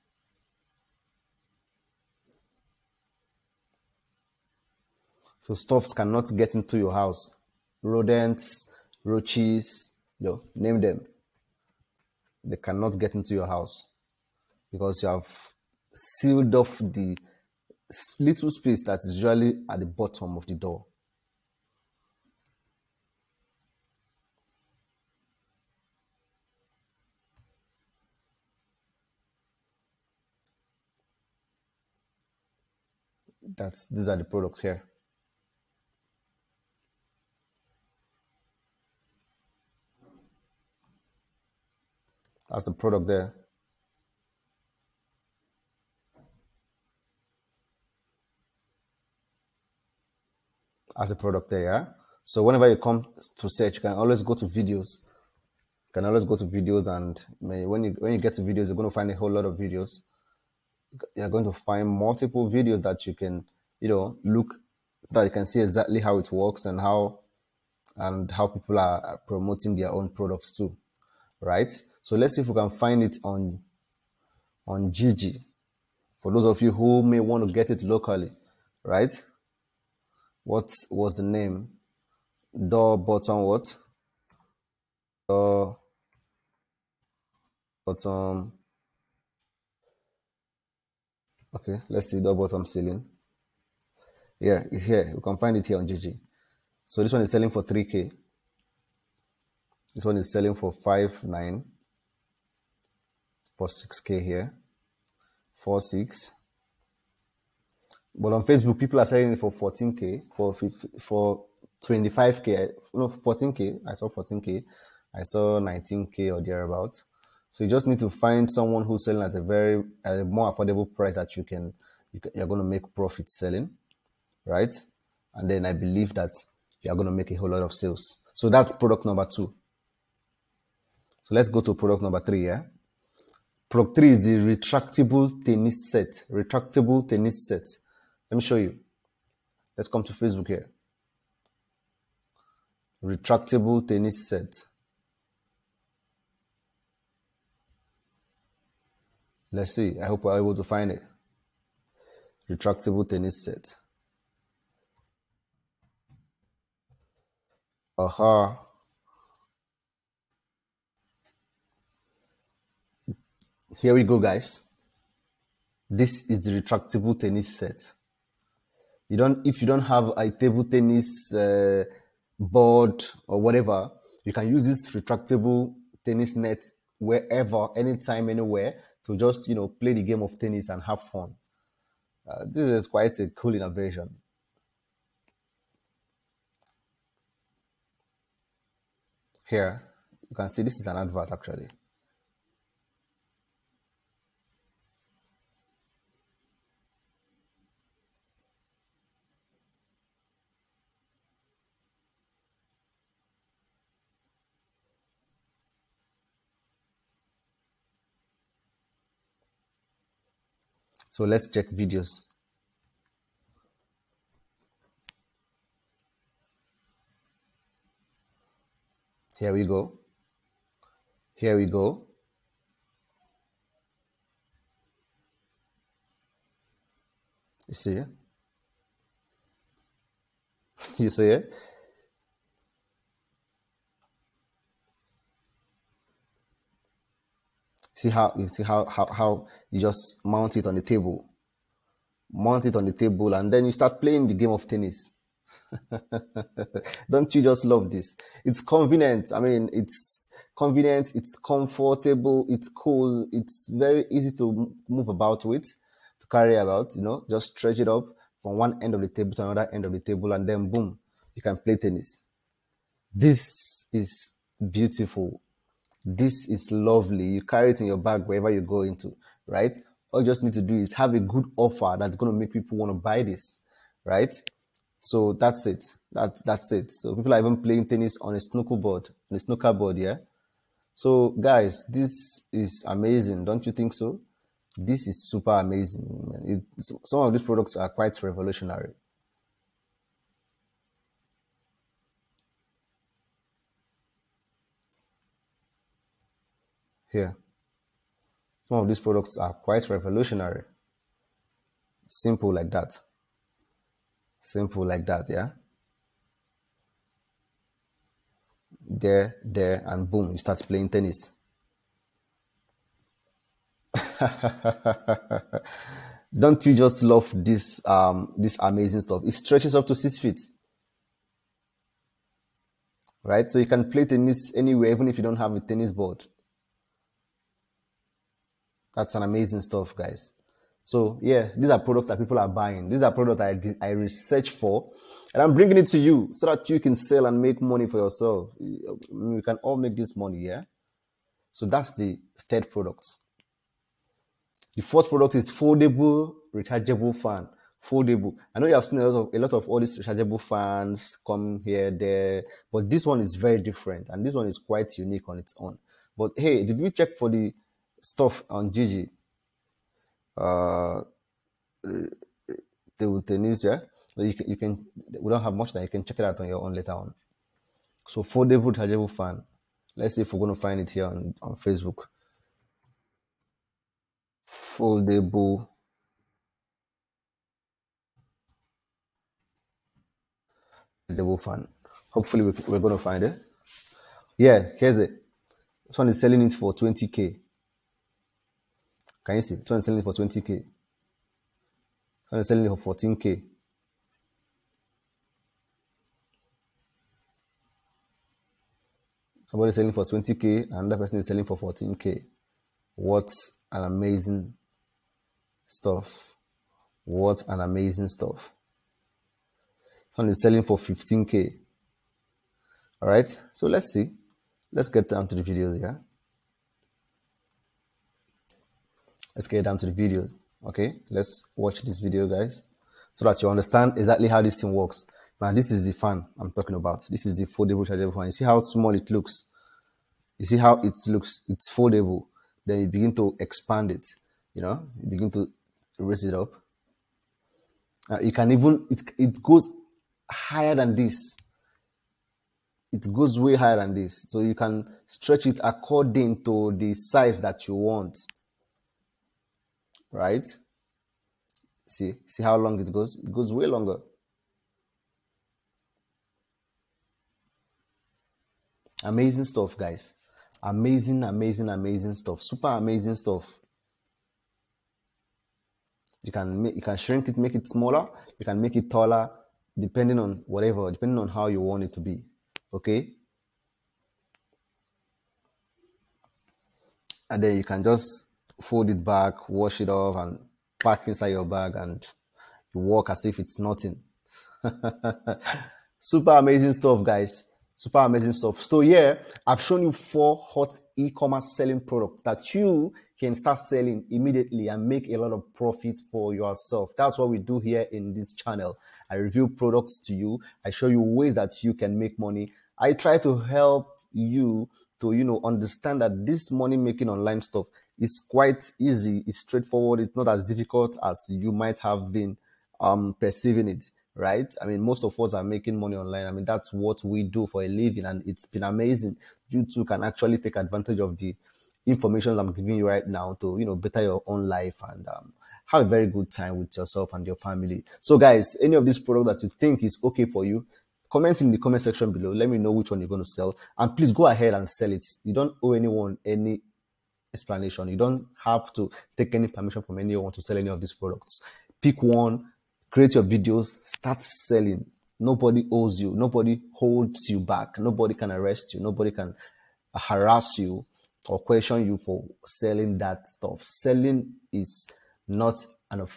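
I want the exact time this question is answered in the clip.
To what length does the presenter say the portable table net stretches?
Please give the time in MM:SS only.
05:19.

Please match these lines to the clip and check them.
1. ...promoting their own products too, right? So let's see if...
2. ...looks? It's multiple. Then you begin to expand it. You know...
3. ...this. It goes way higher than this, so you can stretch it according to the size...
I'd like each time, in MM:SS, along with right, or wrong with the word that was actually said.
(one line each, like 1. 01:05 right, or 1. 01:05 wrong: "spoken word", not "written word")
1. 01:09 right
2. 07:11 wrong: "foldable", not "multiple"
3. 07:20 right.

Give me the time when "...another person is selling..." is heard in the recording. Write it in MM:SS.
06:40.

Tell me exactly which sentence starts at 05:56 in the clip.
But hey, did we check for the stuff on Jiji, uh, Tunisia.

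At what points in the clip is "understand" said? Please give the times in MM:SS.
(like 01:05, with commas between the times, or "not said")
07:03, 08:25.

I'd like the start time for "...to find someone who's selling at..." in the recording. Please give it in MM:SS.
01:58.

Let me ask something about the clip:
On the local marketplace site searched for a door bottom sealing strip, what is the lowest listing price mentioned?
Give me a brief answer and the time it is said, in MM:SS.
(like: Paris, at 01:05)
3k, at 01:37.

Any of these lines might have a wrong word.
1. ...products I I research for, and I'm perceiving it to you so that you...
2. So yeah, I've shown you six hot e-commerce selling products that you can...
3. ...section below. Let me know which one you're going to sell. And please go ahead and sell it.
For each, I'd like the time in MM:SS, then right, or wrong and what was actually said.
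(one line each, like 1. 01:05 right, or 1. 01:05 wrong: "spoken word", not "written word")
1. 05:33 wrong: "bringing", not "perceiving"
2. 08:08 wrong: "four", not "six"
3. 08:51 right.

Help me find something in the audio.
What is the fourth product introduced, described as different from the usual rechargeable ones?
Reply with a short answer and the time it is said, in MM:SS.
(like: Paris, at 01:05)
Foldable rechargeable fan, at 05:45.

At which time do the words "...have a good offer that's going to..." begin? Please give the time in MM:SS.
04:30.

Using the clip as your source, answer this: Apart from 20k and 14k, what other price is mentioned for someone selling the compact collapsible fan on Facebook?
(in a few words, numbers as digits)
15k.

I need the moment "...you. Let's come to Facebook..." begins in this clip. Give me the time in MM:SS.
02:18.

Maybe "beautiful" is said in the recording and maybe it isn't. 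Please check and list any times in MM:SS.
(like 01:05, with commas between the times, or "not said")
04:24.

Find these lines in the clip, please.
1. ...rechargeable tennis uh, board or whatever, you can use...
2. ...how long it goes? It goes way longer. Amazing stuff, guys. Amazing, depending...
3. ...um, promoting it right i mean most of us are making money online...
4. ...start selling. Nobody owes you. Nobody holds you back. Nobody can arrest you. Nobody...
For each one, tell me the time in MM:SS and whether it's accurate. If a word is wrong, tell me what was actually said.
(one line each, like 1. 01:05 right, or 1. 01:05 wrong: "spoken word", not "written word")
1. 02:50 wrong: "table", not "rechargeable"
2. 07:32 wrong: "amazing", not "depending"
3. 08:32 wrong: "perceiving", not "promoting"
4. 09:03 right.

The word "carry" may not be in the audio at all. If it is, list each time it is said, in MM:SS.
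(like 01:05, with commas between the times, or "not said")
04:16, 04:27.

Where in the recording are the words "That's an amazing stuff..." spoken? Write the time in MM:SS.
05:28.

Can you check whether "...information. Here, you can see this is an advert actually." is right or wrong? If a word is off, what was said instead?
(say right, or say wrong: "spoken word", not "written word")
wrong: "innovation", not "information".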